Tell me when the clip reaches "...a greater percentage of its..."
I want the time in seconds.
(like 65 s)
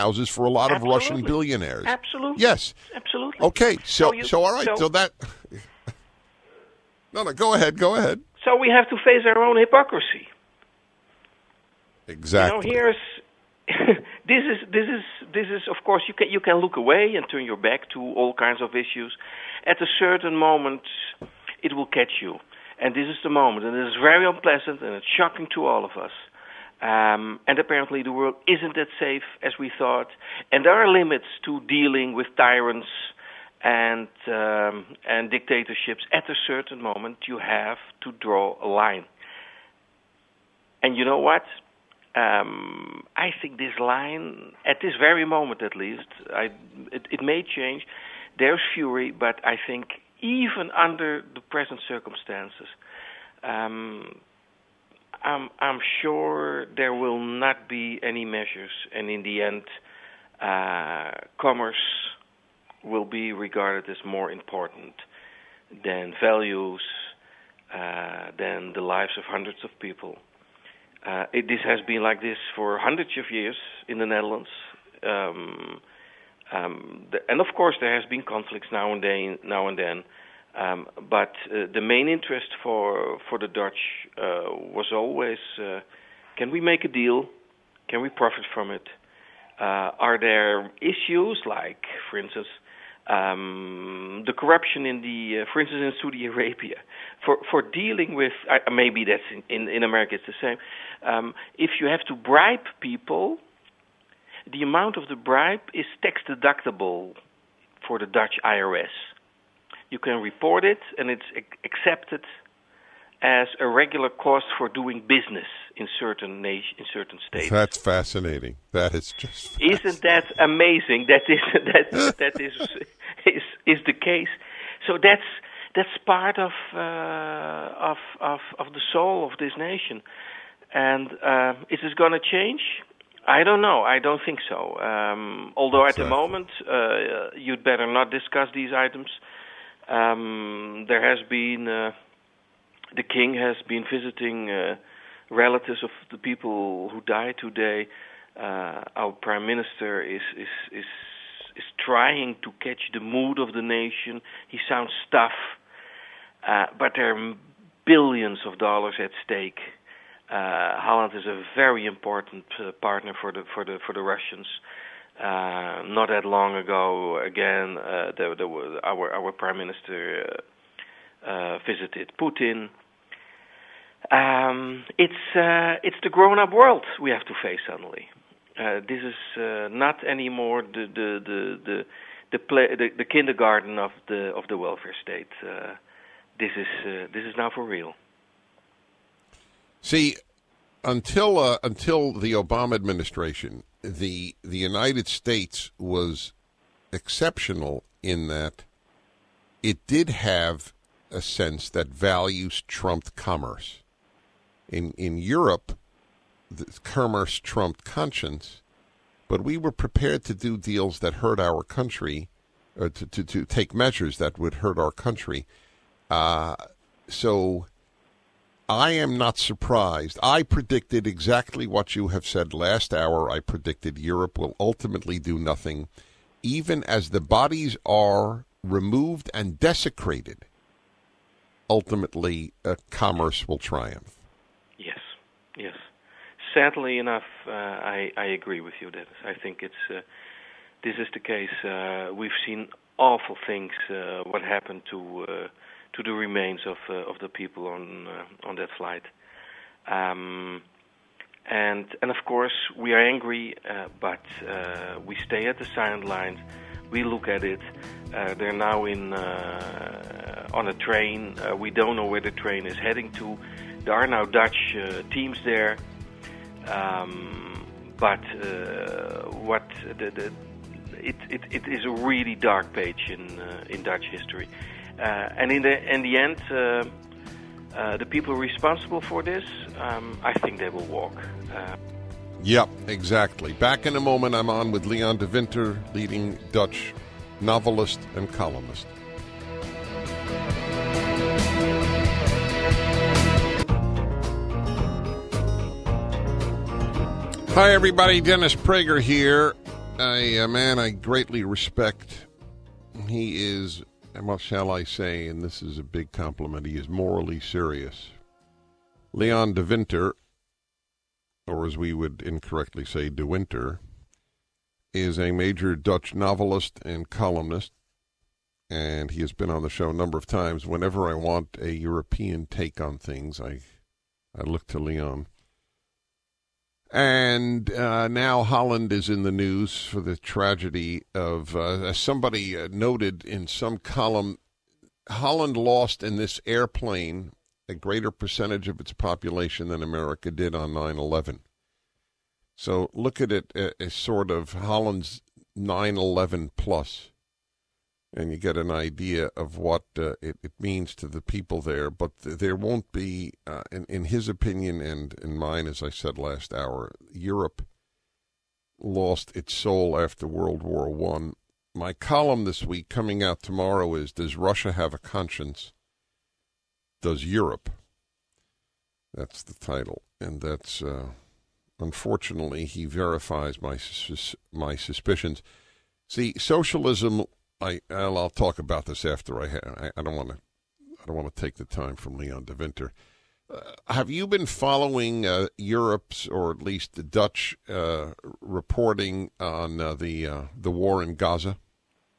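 337 s.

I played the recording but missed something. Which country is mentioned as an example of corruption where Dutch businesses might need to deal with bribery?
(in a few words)
Saudi Arabia.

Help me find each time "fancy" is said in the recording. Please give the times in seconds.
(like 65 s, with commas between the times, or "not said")
not said.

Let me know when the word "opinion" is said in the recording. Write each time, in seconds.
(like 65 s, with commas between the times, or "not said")
354 s.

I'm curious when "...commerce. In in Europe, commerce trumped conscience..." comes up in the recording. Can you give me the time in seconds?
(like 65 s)
203 s.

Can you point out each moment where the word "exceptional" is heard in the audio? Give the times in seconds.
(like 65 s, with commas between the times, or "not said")
196 s.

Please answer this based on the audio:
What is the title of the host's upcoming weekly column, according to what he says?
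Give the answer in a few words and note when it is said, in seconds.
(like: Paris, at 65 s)
Does Russia Have a Conscience? Does Europe?, at 364 s.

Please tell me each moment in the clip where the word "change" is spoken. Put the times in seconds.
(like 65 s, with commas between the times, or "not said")
47 s, 132 s.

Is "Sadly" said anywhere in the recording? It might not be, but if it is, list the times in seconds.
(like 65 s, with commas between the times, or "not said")
236 s.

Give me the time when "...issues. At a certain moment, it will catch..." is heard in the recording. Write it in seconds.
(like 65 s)
18 s.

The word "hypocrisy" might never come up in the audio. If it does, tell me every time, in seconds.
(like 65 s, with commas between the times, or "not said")
9 s.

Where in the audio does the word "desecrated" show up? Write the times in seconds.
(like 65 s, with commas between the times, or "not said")
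229 s.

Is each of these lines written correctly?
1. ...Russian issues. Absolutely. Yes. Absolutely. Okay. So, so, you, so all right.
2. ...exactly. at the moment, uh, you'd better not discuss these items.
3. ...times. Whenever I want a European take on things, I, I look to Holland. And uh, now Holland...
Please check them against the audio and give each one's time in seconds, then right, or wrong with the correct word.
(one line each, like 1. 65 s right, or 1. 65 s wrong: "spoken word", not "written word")
1. 0 s wrong: "billionaires", not "issues"
2. 135 s right
3. 320 s wrong: "Leon", not "Holland".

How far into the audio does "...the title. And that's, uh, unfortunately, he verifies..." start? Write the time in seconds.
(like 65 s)
369 s.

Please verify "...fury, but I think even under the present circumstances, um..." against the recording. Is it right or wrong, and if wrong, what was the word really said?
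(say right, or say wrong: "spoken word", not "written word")
right.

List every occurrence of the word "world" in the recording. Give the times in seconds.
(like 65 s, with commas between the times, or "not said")
28 s, 176 s, 360 s.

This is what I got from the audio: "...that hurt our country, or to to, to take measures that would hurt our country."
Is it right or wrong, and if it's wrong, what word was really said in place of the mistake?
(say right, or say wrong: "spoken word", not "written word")
right.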